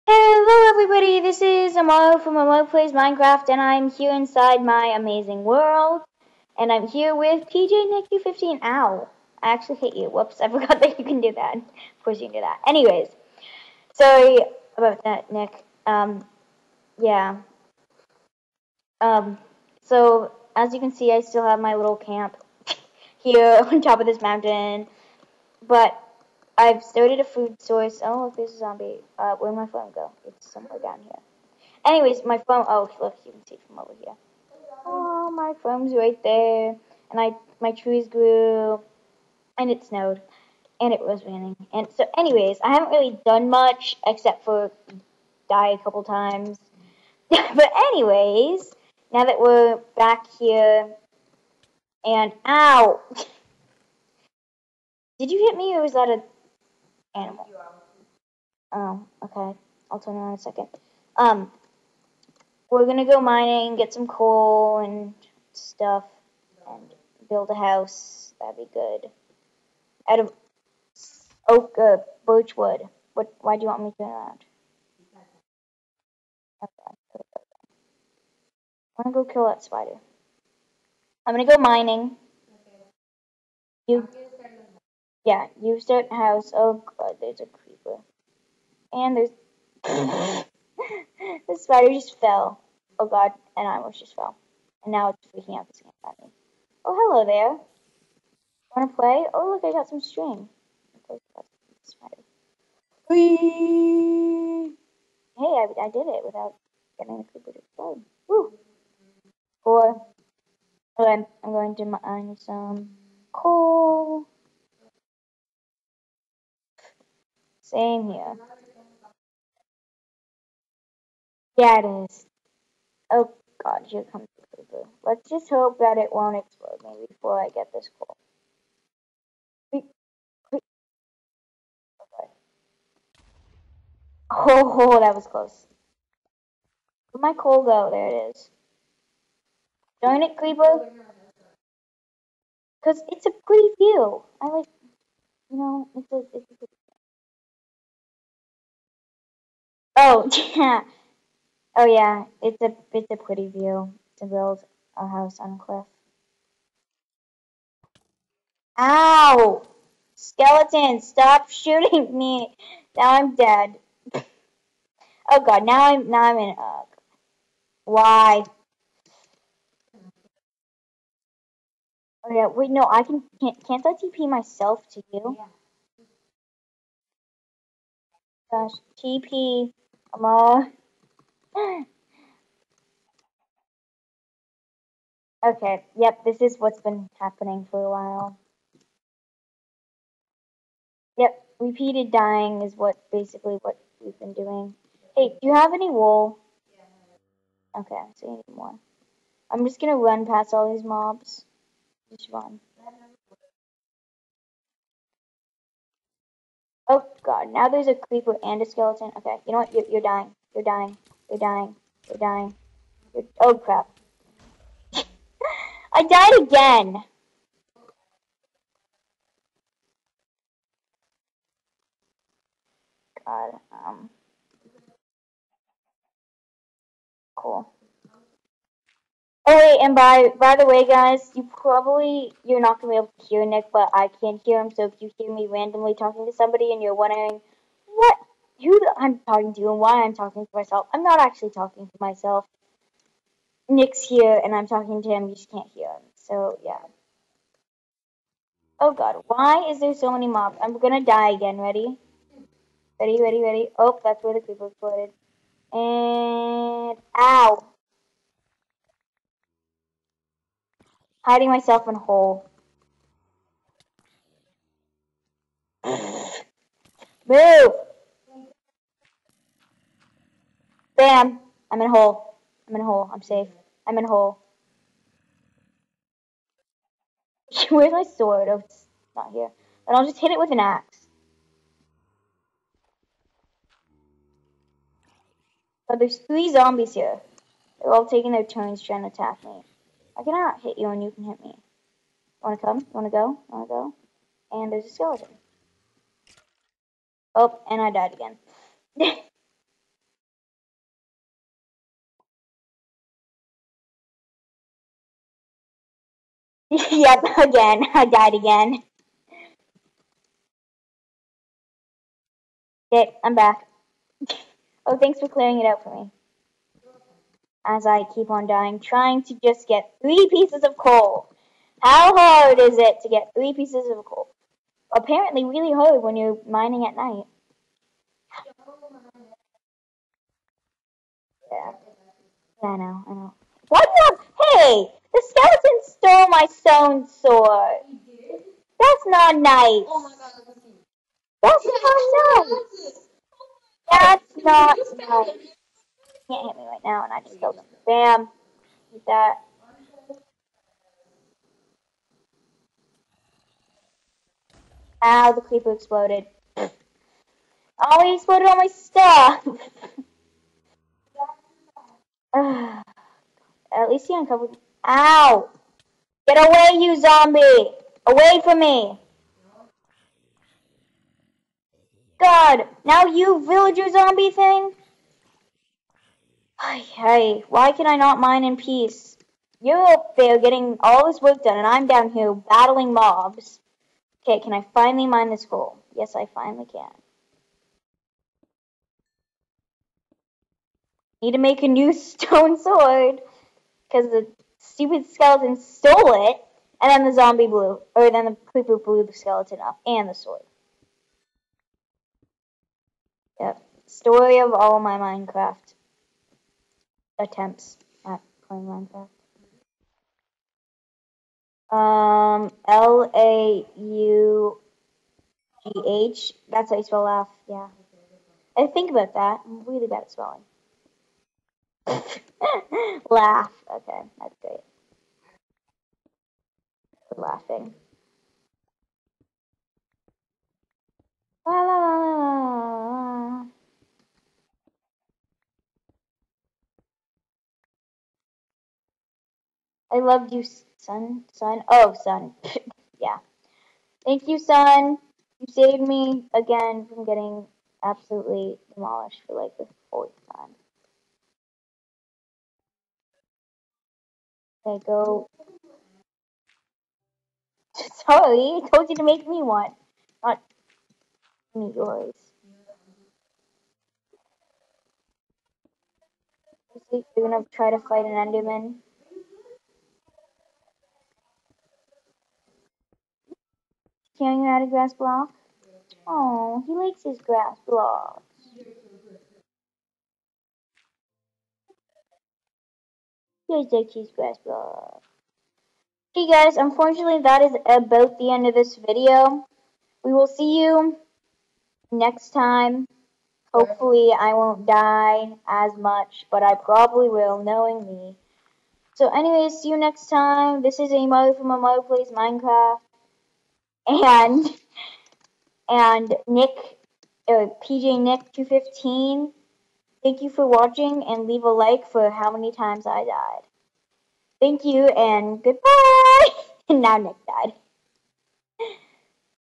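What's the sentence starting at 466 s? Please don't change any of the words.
You're gonna try to fight an Enderman.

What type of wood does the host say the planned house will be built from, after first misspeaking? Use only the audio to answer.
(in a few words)
Birch wood.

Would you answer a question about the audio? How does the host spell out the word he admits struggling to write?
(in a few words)
L A U G H.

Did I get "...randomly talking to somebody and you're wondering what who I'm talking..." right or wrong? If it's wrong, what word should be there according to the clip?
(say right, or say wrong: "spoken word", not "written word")
right.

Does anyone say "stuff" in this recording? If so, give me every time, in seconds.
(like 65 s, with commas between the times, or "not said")
65 s, 358 s.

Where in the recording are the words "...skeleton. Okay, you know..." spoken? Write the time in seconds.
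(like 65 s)
208 s.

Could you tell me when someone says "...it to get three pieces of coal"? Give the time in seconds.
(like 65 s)
322 s.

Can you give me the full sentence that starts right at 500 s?
This is Amar from Amar Plays Minecraft.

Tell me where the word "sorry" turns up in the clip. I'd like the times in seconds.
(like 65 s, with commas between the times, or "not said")
13 s, 458 s.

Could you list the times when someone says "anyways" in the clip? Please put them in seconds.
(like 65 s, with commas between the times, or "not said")
12 s, 31 s, 42 s, 47 s, 499 s.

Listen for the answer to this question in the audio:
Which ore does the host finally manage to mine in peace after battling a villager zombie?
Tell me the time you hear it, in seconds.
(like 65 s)
385 s.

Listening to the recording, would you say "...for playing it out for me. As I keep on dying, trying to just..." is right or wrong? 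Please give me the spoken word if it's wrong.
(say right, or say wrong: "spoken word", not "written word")
wrong: "clearing", not "playing".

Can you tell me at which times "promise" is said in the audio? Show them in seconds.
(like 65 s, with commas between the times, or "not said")
not said.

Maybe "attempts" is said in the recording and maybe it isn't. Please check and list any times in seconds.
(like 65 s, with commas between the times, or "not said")
407 s.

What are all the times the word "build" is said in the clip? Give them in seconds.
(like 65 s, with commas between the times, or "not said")
67 s, 154 s.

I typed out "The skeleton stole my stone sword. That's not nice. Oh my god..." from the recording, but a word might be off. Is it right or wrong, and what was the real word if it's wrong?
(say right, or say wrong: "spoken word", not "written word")
right.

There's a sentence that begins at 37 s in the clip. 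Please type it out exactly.
And I, my trees grew, and it snowed, and it was raining.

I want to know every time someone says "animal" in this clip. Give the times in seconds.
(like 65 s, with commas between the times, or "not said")
57 s.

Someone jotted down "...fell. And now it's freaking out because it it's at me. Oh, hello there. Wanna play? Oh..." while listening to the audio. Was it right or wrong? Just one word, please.
right.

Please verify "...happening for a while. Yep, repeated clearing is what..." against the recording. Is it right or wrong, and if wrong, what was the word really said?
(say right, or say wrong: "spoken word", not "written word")
wrong: "dying", not "clearing".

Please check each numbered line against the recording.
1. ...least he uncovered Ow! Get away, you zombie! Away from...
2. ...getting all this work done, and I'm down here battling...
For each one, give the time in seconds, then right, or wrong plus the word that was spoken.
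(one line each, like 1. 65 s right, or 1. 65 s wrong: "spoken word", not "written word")
1. 363 s right
2. 380 s right.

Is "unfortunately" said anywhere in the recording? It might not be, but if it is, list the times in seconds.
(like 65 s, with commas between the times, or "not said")
486 s.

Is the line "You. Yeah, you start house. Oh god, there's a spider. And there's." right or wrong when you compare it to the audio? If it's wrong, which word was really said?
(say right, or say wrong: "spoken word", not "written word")
wrong: "creeper", not "spider".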